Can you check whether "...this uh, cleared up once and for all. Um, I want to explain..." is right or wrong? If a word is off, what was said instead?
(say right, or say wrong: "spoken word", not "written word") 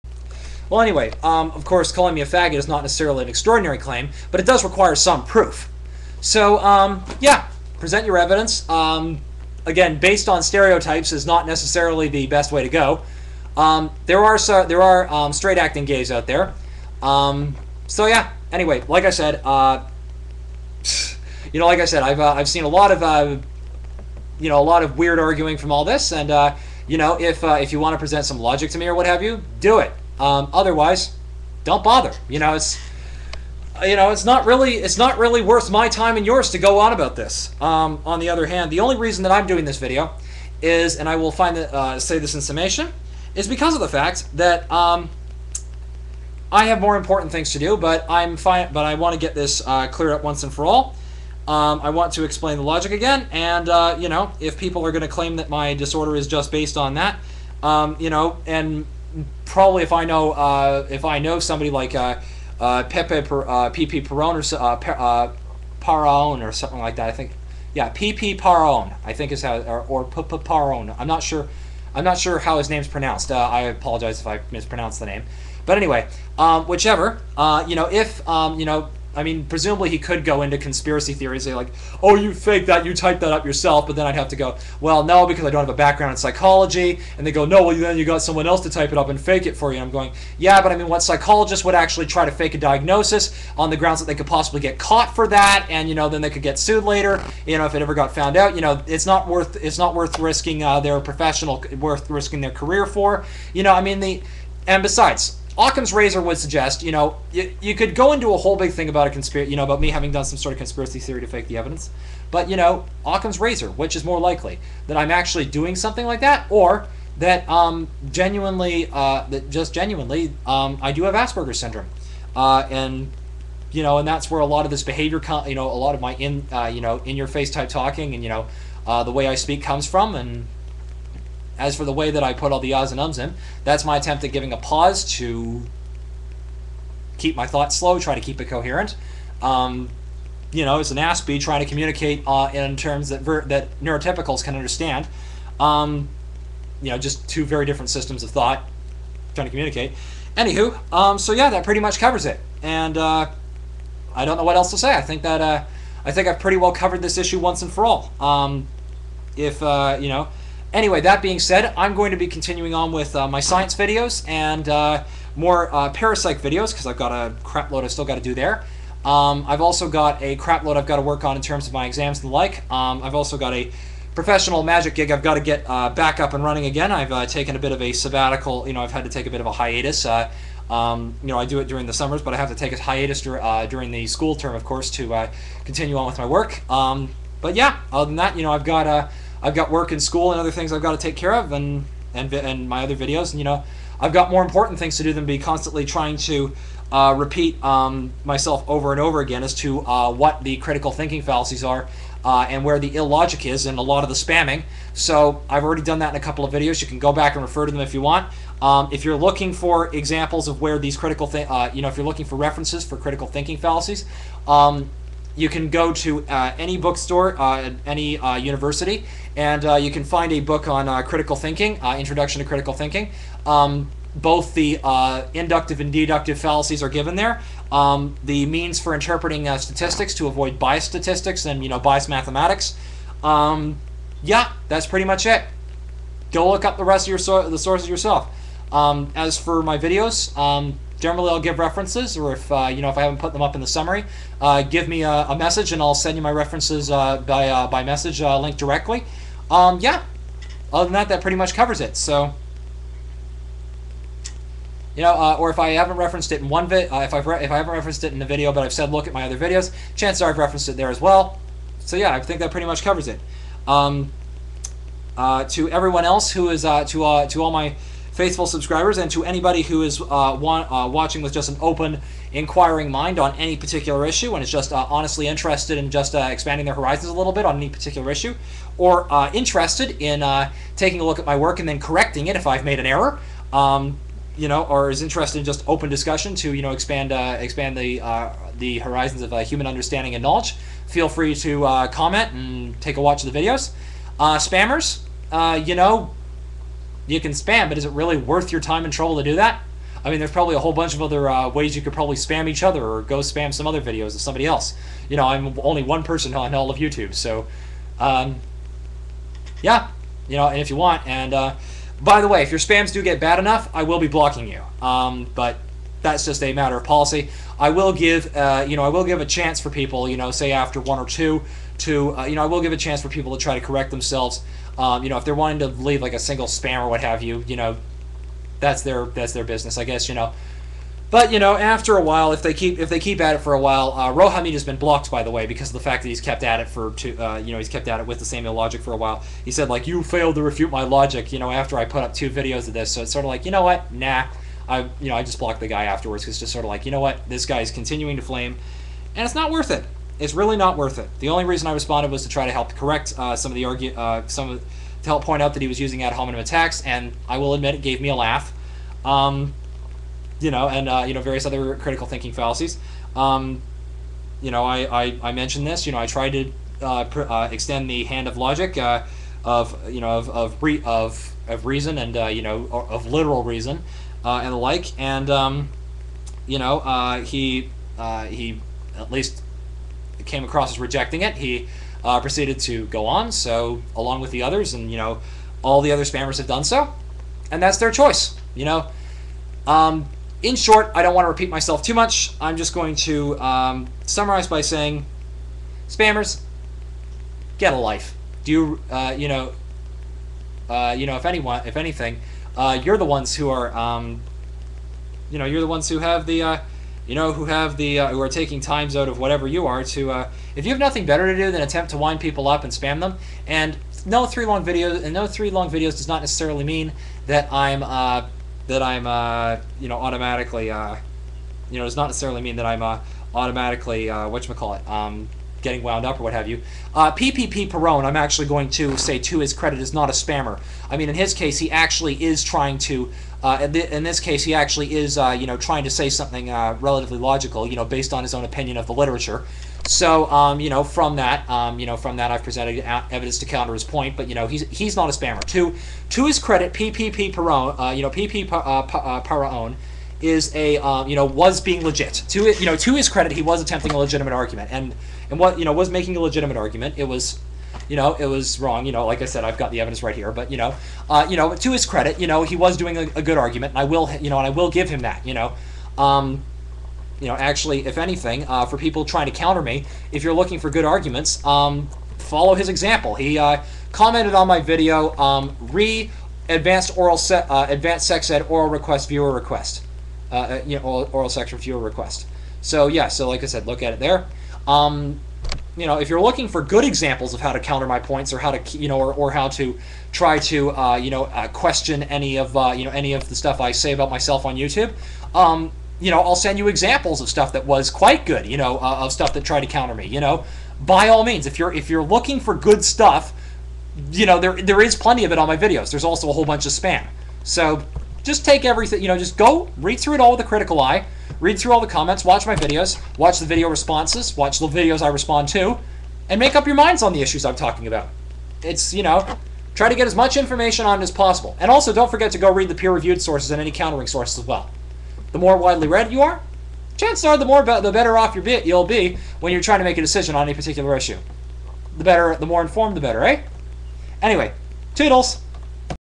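right.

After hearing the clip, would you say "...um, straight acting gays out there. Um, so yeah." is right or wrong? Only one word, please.
right.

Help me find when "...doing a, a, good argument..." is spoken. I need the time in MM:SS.
07:42.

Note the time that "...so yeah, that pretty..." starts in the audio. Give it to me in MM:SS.
02:31.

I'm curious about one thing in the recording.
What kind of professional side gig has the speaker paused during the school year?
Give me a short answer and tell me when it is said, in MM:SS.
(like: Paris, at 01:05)
Magic, at 02:54.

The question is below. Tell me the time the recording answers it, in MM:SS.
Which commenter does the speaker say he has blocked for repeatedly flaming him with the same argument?
05:34.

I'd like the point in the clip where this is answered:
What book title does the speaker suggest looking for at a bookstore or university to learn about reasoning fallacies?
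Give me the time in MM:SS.
03:41.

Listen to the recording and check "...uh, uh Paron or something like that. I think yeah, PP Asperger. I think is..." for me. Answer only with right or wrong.
wrong.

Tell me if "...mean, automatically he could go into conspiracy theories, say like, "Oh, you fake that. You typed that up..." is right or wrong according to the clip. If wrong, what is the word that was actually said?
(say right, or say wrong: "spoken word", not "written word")
wrong: "presumably", not "automatically".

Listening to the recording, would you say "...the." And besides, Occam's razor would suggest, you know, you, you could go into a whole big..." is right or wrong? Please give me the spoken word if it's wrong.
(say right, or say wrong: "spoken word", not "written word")
right.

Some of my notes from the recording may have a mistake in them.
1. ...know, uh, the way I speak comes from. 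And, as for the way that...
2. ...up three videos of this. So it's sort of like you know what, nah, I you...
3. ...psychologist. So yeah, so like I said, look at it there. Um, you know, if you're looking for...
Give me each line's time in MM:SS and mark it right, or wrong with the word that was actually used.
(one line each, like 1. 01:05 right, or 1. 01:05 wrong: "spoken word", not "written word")
1. 02:08 right
2. 05:42 wrong: "two", not "three"
3. 08:01 wrong: "request", not "psychologist".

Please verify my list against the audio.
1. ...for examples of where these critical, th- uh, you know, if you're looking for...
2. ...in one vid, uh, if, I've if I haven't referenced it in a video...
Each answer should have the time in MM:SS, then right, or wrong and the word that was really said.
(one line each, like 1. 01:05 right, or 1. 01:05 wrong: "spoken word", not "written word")
1. 03:29 right
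2. 04:16 right.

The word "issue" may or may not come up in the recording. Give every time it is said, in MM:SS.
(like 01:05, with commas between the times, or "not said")
02:37, 04:34, 04:38, 08:37, 08:50.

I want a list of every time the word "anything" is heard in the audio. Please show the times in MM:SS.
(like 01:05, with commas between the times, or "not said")
06:41, 07:47.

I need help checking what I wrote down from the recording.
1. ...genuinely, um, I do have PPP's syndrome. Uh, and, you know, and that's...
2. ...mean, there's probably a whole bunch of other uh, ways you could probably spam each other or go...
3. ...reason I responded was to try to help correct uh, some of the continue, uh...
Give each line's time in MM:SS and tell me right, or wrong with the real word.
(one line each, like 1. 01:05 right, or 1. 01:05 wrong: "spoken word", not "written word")
1. 01:59 wrong: "Asperger", not "PPP"
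2. 05:00 right
3. 05:51 wrong: "argue", not "continue".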